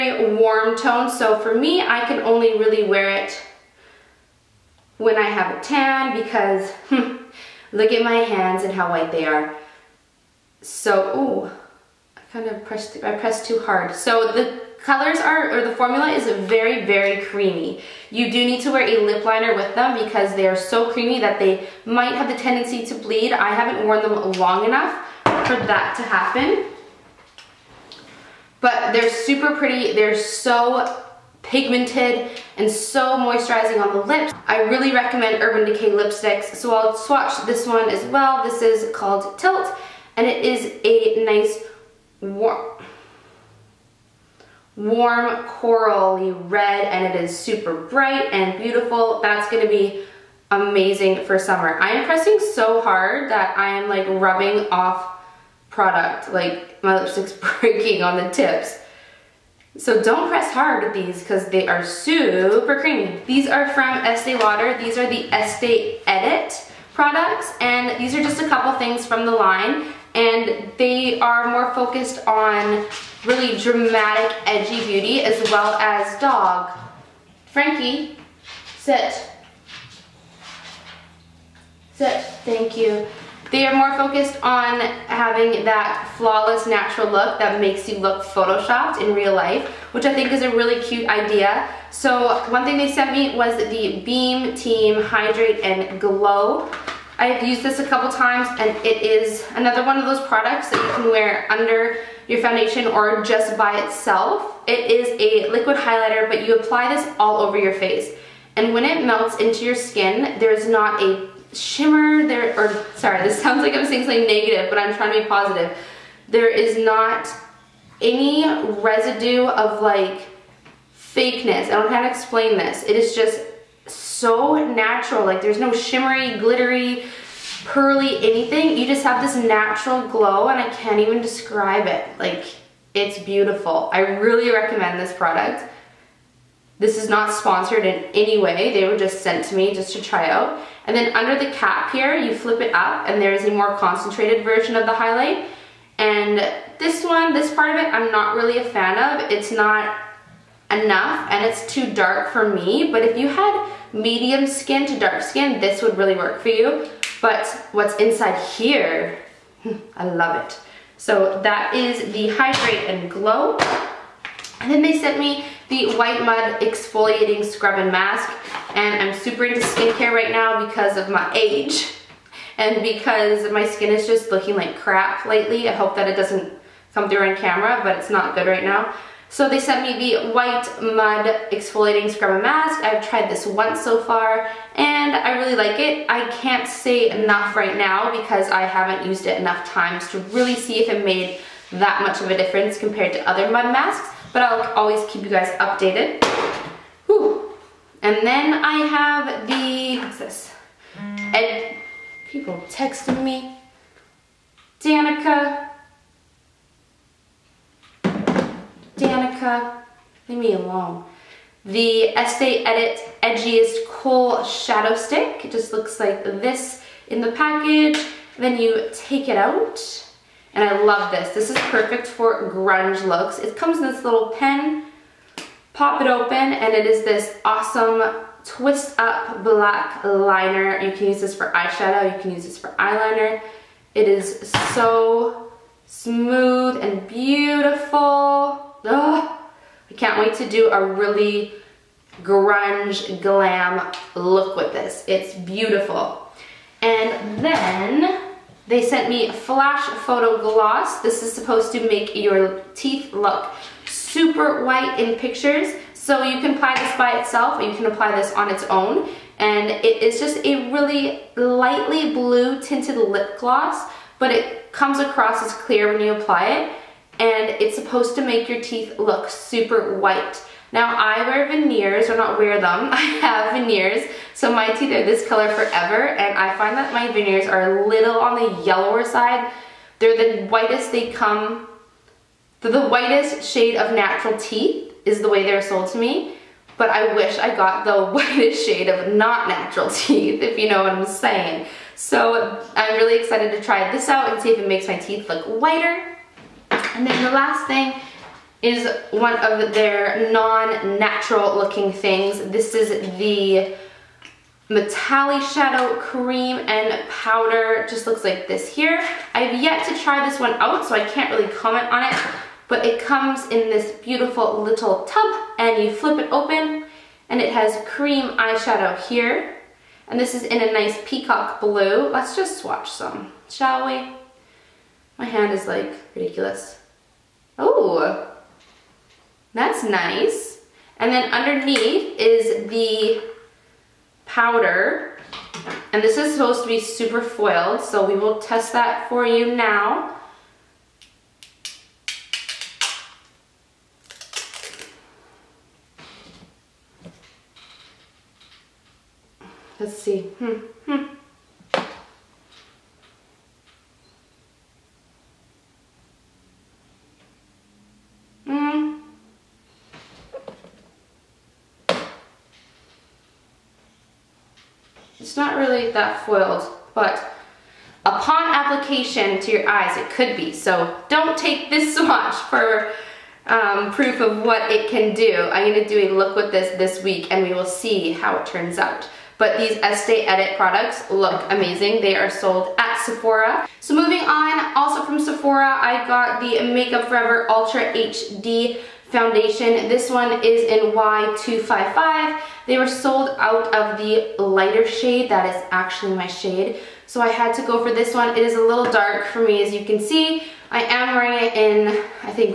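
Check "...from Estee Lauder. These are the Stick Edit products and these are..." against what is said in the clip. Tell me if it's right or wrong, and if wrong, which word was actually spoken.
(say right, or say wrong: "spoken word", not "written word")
wrong: "Estee", not "Stick".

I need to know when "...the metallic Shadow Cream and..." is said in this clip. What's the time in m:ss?
5:03.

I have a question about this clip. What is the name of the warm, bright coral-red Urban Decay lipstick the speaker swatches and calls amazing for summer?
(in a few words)
Tilt.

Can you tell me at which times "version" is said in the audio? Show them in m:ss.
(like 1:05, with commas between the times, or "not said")
2:24.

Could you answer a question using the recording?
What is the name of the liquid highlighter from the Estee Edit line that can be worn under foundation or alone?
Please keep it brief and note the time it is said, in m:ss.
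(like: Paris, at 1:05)
Beam Team Hydrate and Glow, at 1:34.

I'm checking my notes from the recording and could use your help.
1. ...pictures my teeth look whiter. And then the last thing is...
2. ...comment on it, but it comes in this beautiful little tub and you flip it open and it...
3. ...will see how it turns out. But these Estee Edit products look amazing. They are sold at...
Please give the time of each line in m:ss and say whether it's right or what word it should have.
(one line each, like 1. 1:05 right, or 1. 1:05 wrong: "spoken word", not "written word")
1. 4:54 wrong: "makes", not "pictures"
2. 5:11 right
3. 6:17 right.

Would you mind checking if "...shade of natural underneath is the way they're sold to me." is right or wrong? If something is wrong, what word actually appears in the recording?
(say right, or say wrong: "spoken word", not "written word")
wrong: "teeth", not "underneath".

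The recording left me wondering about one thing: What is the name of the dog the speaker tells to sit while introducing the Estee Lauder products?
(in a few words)
Frankie.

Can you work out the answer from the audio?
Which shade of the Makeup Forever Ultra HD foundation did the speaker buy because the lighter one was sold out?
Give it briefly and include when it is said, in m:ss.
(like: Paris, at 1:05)
Y255, at 6:30.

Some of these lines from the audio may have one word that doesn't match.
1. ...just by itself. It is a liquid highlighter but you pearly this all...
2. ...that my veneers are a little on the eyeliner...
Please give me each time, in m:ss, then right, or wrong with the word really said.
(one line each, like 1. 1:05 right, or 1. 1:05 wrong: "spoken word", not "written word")
1. 1:43 wrong: "apply", not "pearly"
2. 4:36 wrong: "yellower", not "eyeliner".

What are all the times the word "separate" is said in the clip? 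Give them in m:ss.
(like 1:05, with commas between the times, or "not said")
not said.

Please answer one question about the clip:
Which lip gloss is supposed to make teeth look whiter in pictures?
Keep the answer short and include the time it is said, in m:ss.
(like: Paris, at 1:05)
Flash Photo Gloss, at 4:09.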